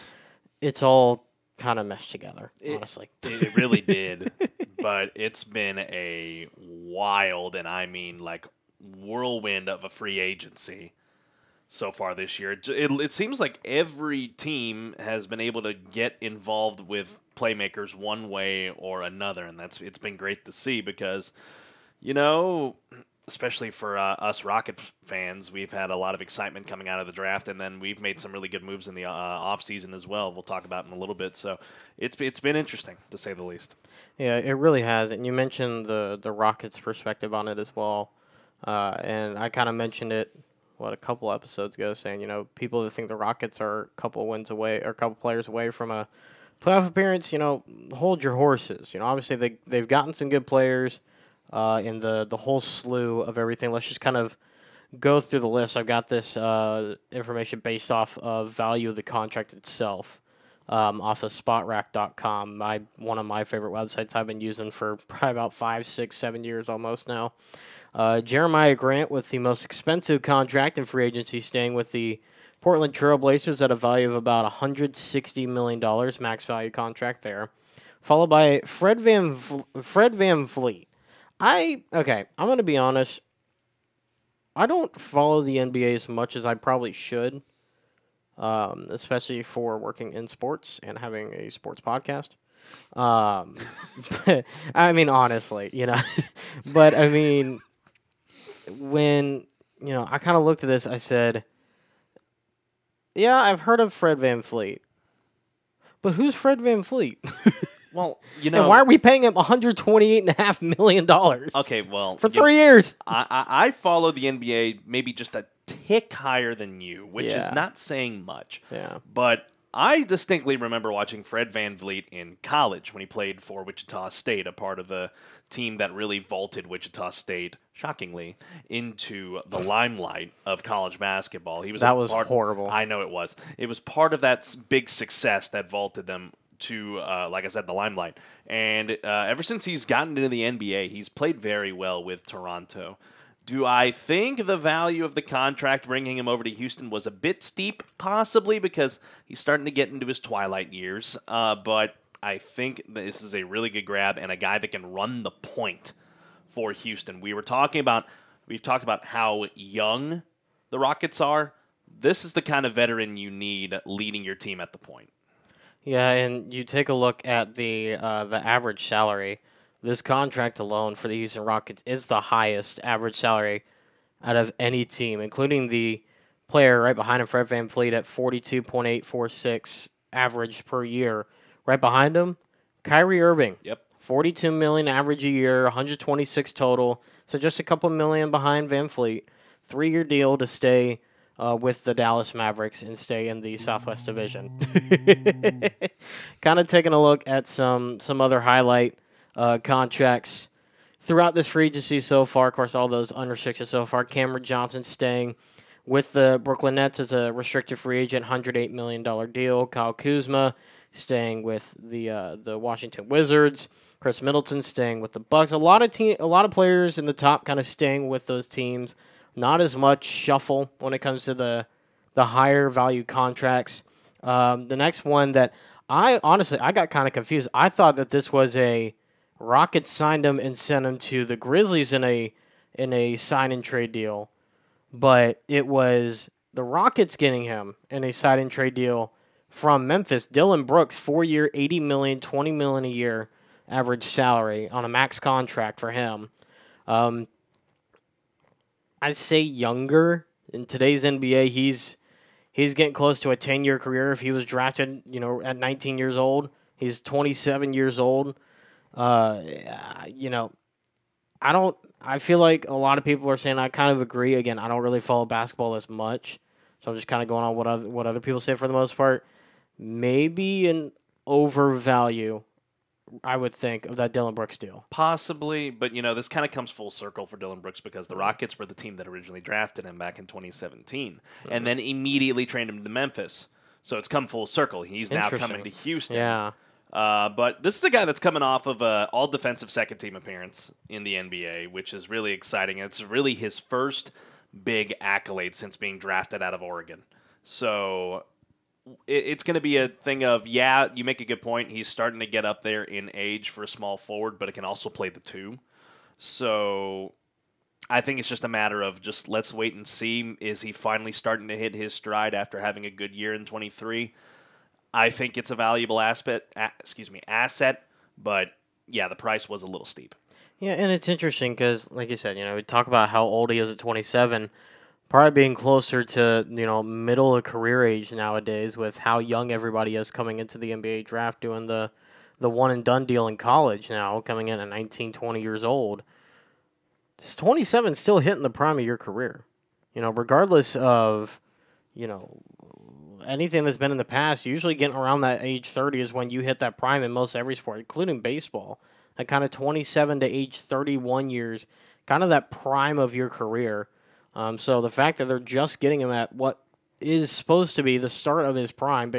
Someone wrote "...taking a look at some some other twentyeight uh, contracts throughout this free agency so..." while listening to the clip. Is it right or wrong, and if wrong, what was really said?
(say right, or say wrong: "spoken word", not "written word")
wrong: "highlight", not "twentyeight".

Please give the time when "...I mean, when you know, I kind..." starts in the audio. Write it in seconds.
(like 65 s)
96 s.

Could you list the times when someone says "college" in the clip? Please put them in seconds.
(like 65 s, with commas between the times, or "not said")
122 s, 130 s, 333 s.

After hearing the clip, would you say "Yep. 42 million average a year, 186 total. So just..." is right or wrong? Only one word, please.
wrong.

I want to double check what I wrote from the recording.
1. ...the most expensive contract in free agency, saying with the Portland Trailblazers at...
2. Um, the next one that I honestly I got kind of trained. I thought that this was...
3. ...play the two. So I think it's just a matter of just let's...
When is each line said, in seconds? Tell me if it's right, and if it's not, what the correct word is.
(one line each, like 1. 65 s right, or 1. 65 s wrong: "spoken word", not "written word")
1. 69 s wrong: "staying", not "saying"
2. 224 s wrong: "confused", not "trained"
3. 304 s right.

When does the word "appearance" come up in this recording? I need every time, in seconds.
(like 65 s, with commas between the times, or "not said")
46 s, 290 s.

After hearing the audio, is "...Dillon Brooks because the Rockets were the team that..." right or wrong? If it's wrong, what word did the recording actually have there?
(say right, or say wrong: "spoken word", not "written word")
right.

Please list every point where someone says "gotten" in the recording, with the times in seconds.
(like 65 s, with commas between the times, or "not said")
49 s, 139 s.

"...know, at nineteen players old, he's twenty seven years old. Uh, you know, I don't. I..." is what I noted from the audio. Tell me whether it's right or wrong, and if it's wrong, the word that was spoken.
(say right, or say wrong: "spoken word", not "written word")
wrong: "years", not "players".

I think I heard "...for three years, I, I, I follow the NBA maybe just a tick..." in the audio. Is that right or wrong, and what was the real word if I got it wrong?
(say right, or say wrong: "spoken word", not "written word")
right.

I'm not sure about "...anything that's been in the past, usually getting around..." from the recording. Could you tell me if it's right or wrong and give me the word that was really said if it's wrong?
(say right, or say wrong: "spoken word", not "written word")
right.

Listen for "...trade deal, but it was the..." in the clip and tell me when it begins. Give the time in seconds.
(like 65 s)
233 s.